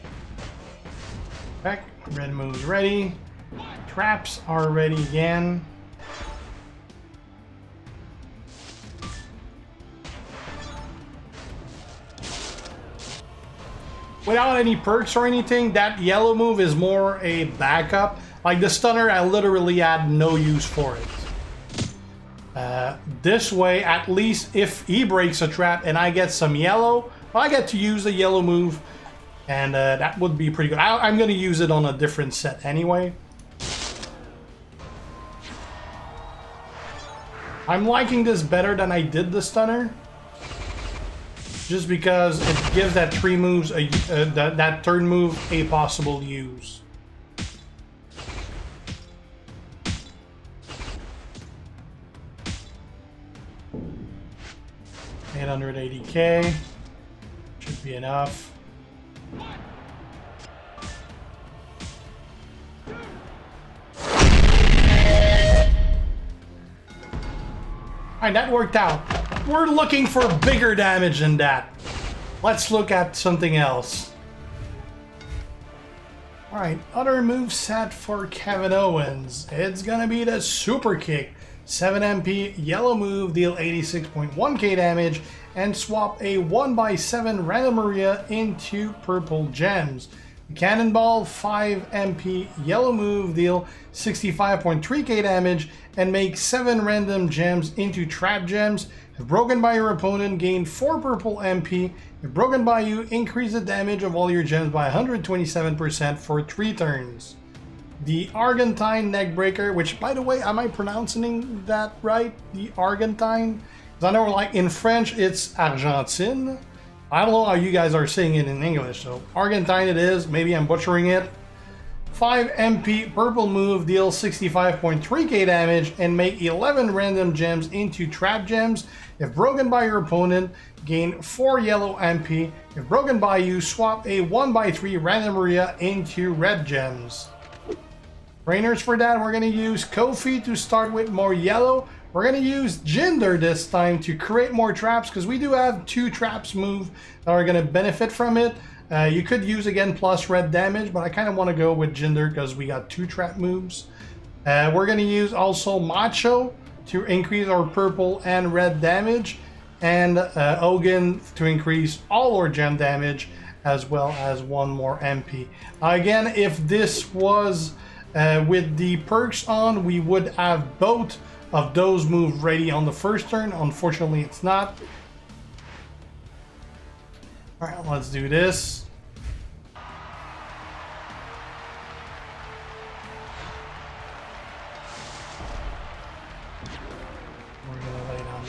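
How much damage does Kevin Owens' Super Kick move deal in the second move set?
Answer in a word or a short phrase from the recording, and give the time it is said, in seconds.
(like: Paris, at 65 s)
86.1k, at 83 s.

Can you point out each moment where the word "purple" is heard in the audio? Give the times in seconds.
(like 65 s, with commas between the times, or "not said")
88 s, 101 s, 123 s, 157 s.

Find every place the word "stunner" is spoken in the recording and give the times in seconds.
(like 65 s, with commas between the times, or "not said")
18 s, 39 s.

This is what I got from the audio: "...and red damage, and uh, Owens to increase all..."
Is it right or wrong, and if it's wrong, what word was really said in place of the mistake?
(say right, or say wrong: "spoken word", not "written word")
wrong: "Ogun", not "Owens".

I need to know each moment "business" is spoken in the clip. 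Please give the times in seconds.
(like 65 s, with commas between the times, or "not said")
not said.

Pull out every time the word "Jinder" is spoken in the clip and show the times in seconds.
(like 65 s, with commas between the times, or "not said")
142 s, 151 s.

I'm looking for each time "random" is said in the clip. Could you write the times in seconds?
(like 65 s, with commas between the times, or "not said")
87 s, 96 s, 126 s, 135 s.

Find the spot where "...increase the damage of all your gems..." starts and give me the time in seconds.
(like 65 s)
103 s.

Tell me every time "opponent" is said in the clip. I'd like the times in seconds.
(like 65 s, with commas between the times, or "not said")
99 s, 129 s.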